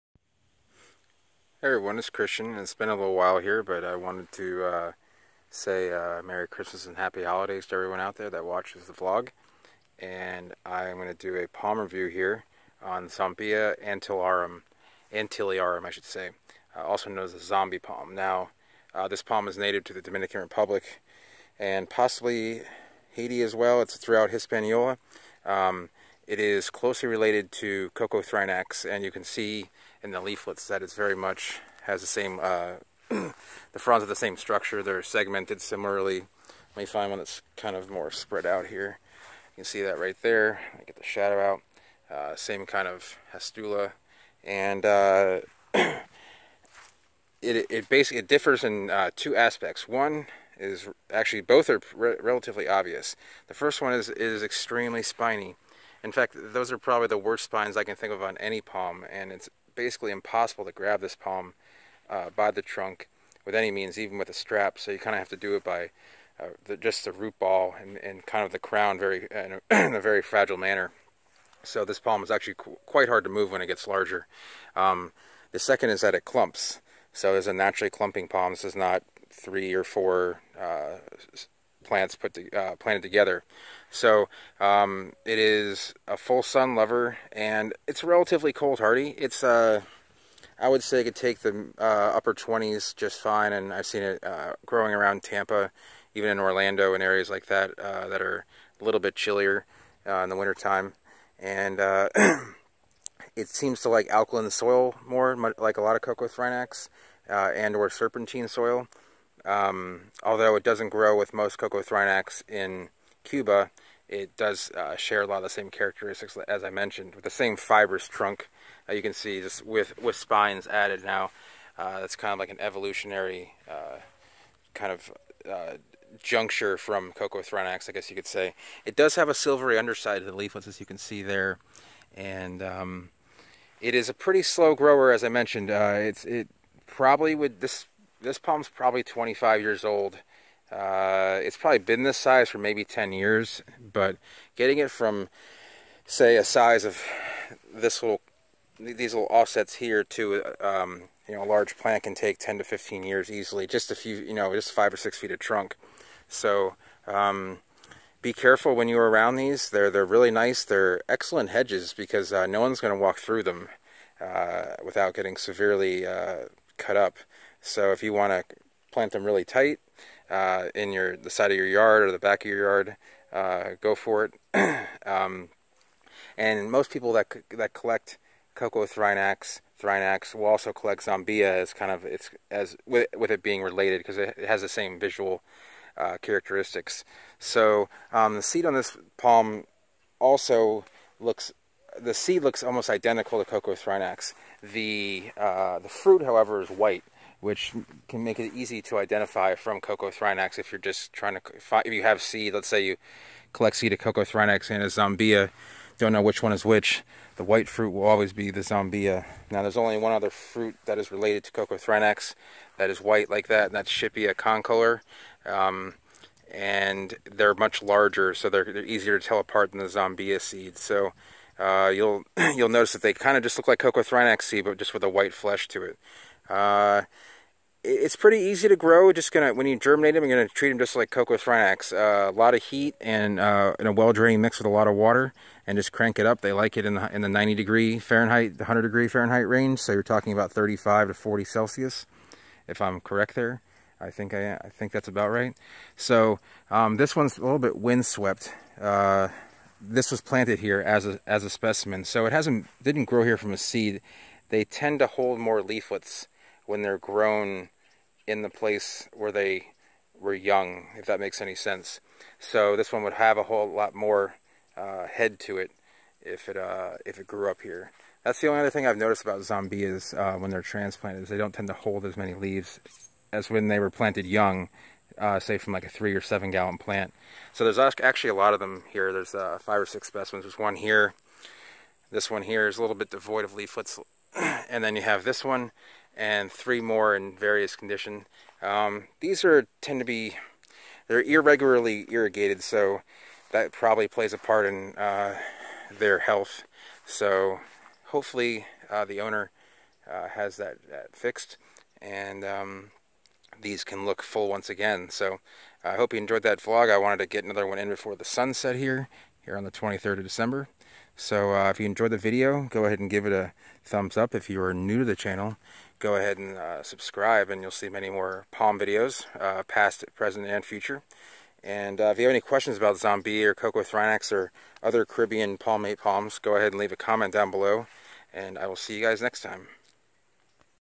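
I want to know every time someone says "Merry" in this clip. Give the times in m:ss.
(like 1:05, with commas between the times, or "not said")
0:06.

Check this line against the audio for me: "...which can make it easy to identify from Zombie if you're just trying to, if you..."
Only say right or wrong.
wrong.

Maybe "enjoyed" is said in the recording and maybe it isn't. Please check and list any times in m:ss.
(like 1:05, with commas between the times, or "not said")
5:06, 5:11.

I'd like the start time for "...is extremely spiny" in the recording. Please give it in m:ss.
0:54.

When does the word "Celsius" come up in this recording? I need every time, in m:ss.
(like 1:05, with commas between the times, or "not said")
4:01.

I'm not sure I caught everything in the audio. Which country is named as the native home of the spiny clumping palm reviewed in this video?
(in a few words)
Dominican Republic.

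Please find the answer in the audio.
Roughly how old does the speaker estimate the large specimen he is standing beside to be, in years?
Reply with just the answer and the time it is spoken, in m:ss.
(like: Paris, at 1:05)
25, at 2:19.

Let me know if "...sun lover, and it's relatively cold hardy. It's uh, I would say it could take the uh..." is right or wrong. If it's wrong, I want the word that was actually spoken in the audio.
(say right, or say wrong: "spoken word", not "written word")
right.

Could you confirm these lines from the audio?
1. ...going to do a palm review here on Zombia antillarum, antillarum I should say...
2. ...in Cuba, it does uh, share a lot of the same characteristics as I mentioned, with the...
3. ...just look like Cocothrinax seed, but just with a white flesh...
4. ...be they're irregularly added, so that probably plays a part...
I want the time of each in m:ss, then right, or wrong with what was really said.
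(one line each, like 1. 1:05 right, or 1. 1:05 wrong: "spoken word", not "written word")
1. 0:10 right
2. 1:52 right
3. 3:43 right
4. 4:50 wrong: "irrigated", not "added".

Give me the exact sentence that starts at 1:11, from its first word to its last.
So this palm is actually qu quite hard to move when it gets larger.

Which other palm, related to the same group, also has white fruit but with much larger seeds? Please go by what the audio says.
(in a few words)
Shippia concolor.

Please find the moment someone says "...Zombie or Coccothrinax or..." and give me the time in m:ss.
5:22.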